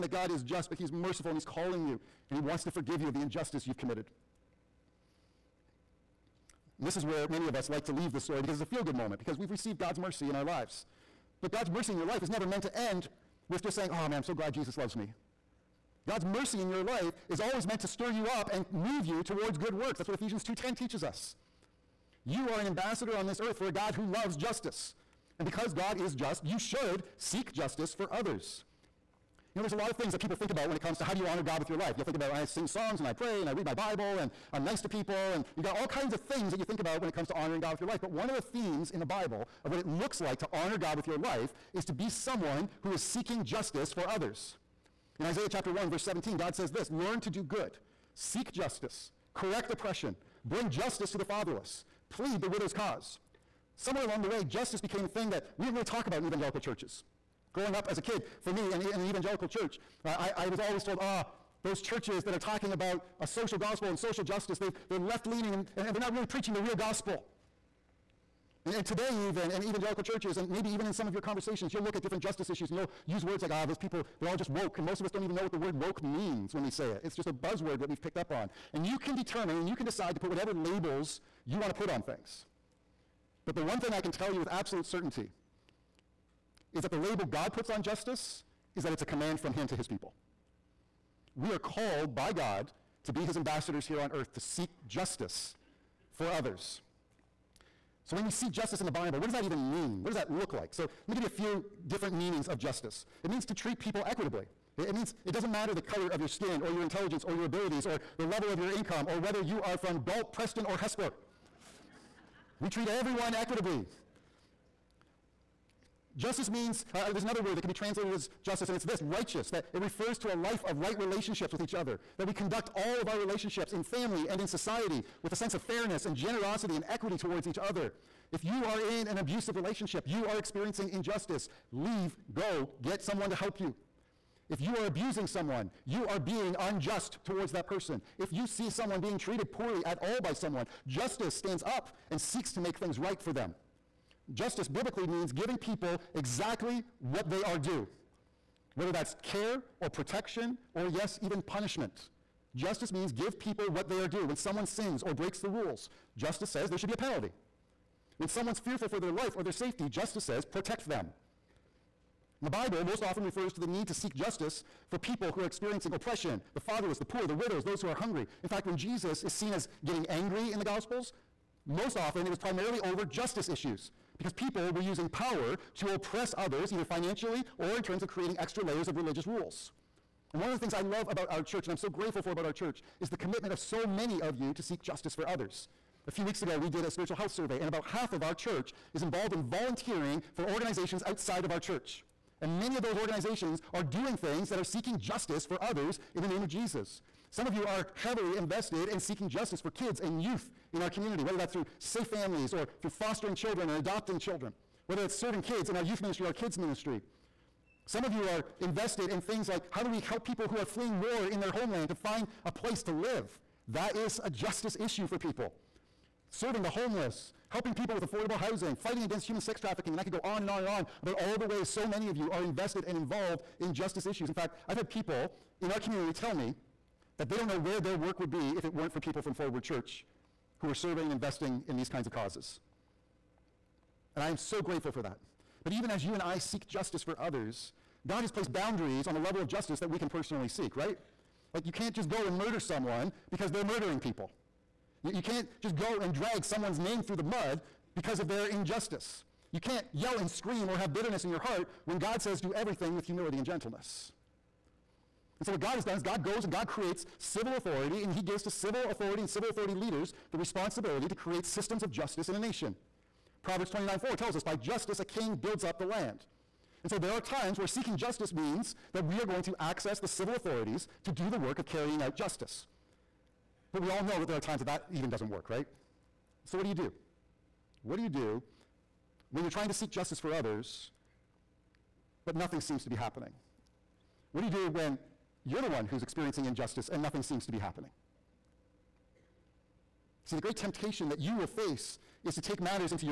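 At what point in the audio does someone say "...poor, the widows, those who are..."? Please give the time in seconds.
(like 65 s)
167 s.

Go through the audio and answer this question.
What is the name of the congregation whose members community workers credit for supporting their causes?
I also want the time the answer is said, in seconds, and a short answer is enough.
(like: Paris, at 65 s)
Forward Church, at 229 s.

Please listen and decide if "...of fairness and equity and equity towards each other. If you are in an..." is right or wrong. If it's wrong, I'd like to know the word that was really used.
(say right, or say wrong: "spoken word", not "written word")
wrong: "generosity", not "equity".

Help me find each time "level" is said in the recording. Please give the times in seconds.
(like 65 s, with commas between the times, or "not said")
108 s, 239 s.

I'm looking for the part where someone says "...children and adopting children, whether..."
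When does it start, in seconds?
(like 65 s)
203 s.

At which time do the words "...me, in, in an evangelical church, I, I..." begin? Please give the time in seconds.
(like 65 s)
58 s.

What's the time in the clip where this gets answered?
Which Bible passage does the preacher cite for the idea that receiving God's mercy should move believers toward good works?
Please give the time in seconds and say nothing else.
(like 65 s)
20 s.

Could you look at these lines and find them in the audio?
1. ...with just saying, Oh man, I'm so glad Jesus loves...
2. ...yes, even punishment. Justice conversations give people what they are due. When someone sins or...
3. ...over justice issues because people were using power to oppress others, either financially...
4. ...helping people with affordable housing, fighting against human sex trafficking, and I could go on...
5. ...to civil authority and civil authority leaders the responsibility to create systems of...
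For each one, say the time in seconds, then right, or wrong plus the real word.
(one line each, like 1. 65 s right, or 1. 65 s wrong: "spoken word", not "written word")
1. 13 s right
2. 150 s wrong: "means", not "conversations"
3. 172 s right
4. 217 s right
5. 258 s right.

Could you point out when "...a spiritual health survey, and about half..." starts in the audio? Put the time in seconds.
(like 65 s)
186 s.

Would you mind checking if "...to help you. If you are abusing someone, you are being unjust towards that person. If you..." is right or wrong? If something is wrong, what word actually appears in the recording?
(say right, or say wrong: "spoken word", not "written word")
right.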